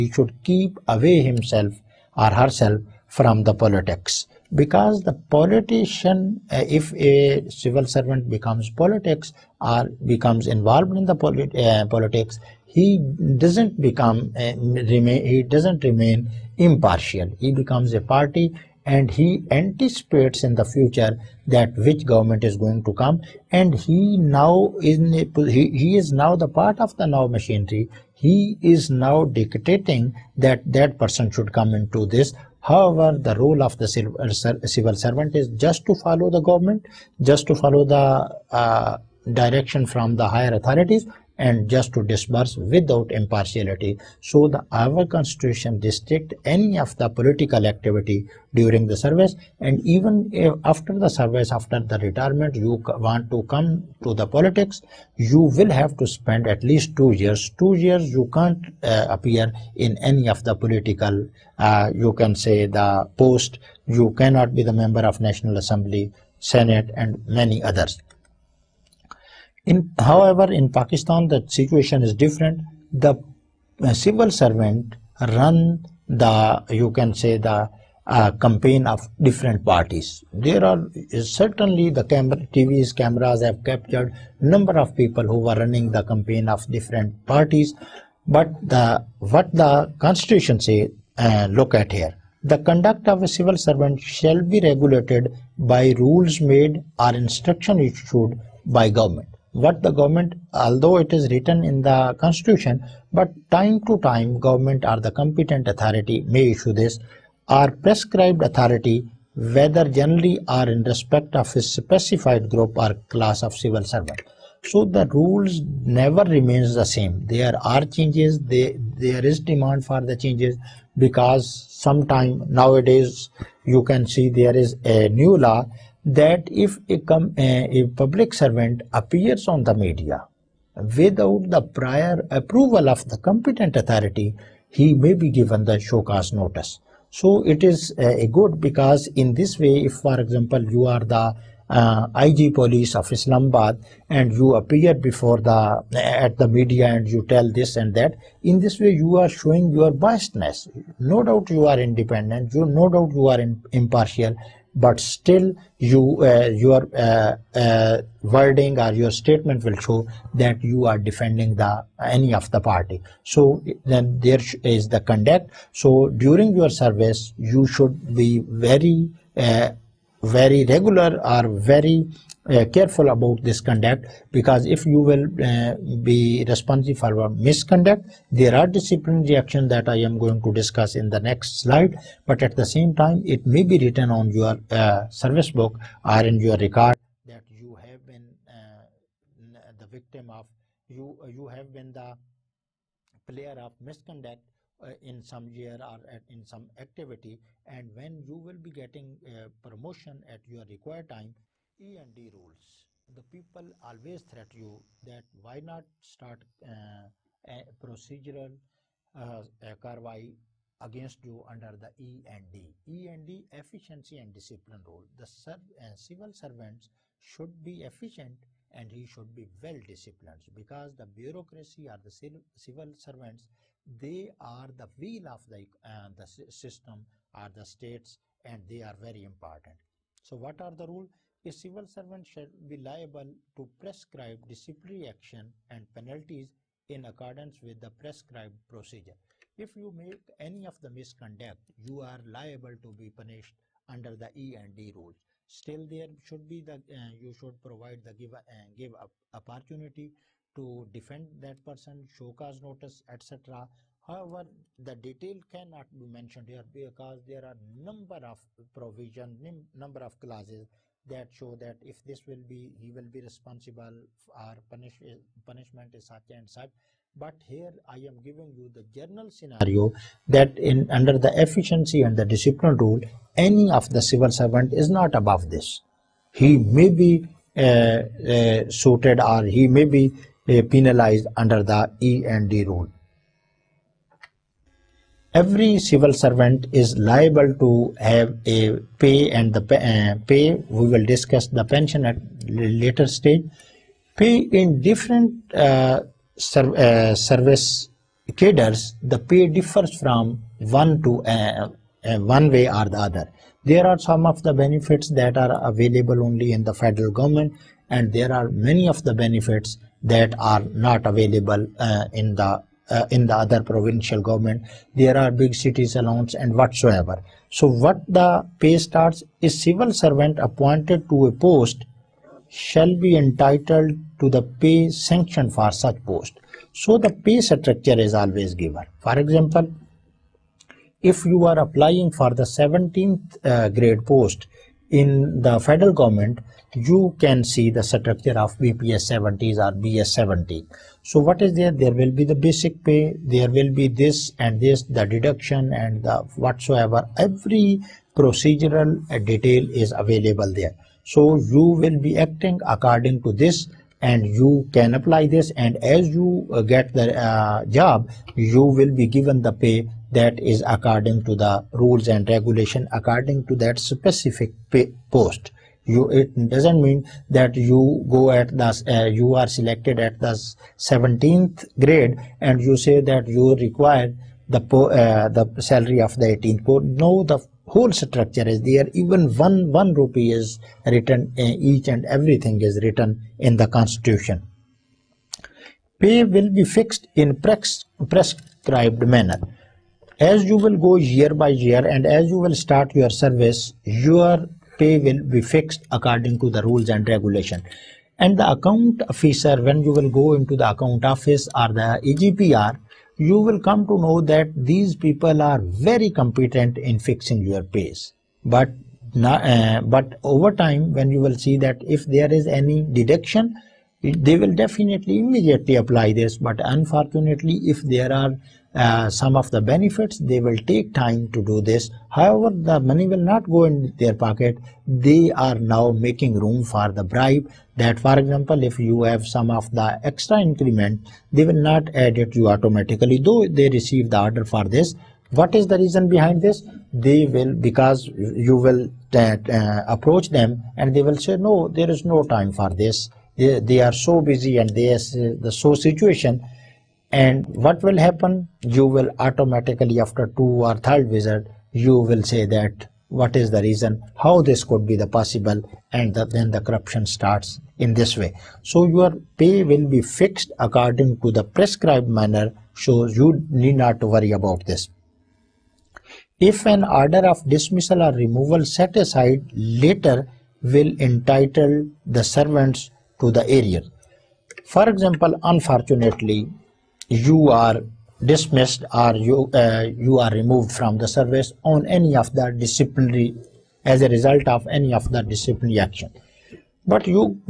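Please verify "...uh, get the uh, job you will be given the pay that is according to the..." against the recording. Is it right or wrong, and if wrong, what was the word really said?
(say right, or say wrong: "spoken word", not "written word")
right.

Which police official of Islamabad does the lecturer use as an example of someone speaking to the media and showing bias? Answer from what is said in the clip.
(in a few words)
IG police.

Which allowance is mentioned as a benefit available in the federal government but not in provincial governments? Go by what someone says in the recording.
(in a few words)
big cities allowance.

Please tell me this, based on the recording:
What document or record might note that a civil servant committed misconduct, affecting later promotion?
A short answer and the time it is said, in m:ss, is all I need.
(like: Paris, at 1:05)
service book, at 3:05.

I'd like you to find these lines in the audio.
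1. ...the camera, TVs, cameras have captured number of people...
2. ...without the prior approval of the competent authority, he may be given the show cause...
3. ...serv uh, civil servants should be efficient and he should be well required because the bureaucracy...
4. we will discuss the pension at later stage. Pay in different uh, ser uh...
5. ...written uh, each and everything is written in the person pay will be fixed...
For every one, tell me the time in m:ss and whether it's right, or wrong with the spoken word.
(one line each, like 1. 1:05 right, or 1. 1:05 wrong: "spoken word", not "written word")
1. 1:21 right
2. 2:10 right
3. 3:35 wrong: "disciplined", not "required"
4. 4:50 right
5. 6:20 wrong: "constitution", not "person".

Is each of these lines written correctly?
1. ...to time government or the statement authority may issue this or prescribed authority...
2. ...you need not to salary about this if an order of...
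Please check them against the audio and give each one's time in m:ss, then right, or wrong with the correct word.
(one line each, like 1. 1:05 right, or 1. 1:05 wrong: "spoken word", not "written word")
1. 1:43 wrong: "competent", not "statement"
2. 7:43 wrong: "worry", not "salary".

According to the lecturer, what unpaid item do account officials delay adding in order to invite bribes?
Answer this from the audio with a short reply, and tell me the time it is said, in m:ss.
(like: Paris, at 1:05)
extra increment, at 7:10.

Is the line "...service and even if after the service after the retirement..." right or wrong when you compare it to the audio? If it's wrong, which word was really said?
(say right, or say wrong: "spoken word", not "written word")
right.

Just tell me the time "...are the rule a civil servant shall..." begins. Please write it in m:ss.
3:50.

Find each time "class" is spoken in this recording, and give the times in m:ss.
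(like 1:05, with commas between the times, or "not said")
1:53.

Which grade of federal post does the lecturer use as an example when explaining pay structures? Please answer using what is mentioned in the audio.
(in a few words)
17th grade.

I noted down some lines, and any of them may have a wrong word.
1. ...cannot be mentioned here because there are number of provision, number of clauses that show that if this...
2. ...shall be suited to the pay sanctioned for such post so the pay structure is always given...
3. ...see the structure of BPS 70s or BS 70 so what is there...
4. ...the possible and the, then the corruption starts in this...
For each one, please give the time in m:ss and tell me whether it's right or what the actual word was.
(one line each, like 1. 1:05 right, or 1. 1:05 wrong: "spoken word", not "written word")
1. 4:15 right
2. 5:22 wrong: "entitled", not "suited"
3. 5:37 right
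4. 7:34 right.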